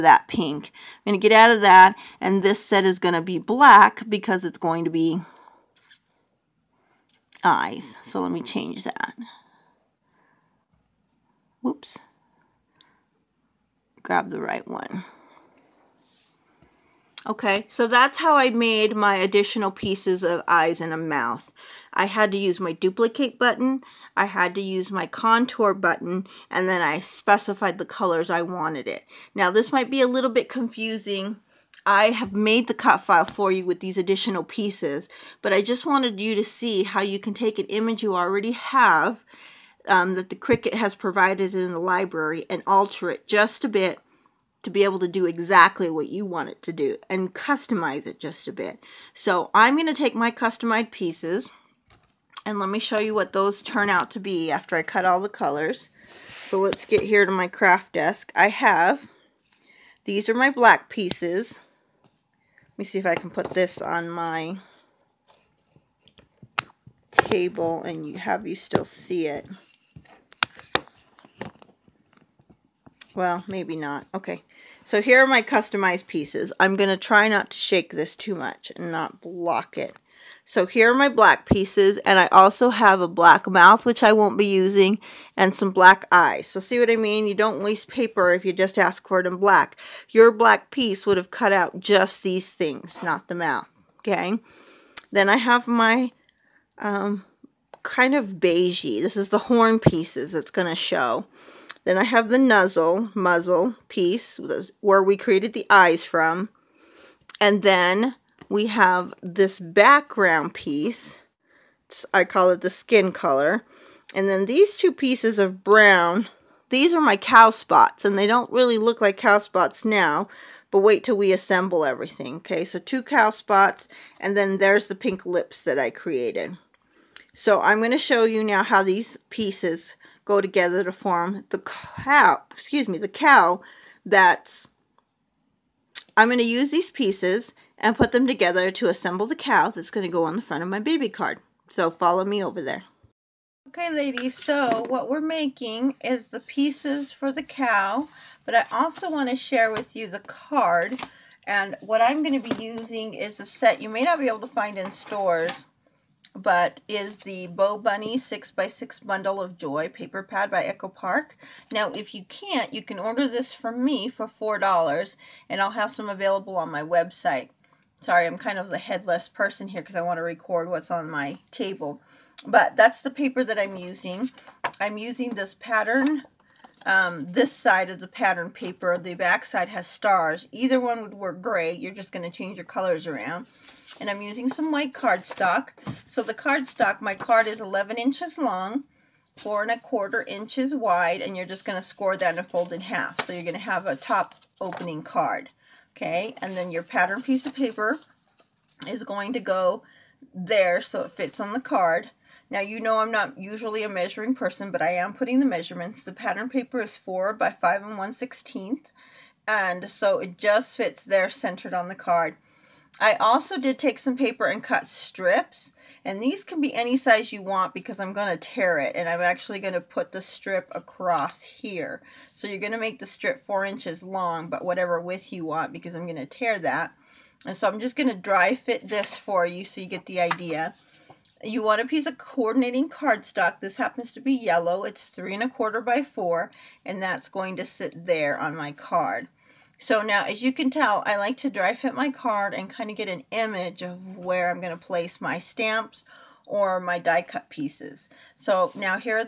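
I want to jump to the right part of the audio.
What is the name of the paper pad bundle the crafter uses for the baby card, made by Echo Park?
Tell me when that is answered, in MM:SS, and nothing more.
02:37.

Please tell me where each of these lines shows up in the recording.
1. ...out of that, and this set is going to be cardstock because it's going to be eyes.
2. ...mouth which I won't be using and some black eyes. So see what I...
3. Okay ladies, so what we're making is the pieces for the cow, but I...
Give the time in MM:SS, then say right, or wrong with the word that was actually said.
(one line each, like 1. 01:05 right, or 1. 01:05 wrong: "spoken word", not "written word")
1. 00:01 wrong: "black", not "cardstock"
2. 01:23 right
3. 02:23 right.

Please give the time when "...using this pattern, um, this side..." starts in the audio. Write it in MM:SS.
02:54.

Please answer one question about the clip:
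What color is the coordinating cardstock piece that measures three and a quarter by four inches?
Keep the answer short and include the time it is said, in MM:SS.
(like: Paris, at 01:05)
Yellow, at 03:54.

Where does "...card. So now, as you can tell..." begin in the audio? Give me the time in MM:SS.
03:58.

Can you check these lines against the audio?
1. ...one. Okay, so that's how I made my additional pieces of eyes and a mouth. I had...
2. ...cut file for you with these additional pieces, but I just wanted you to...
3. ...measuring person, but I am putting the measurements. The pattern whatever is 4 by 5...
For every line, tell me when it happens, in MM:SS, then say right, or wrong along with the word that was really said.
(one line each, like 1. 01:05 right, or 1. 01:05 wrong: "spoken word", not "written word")
1. 00:14 right
2. 00:32 right
3. 03:23 wrong: "paper", not "whatever".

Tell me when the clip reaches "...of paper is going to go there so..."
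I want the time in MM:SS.
03:17.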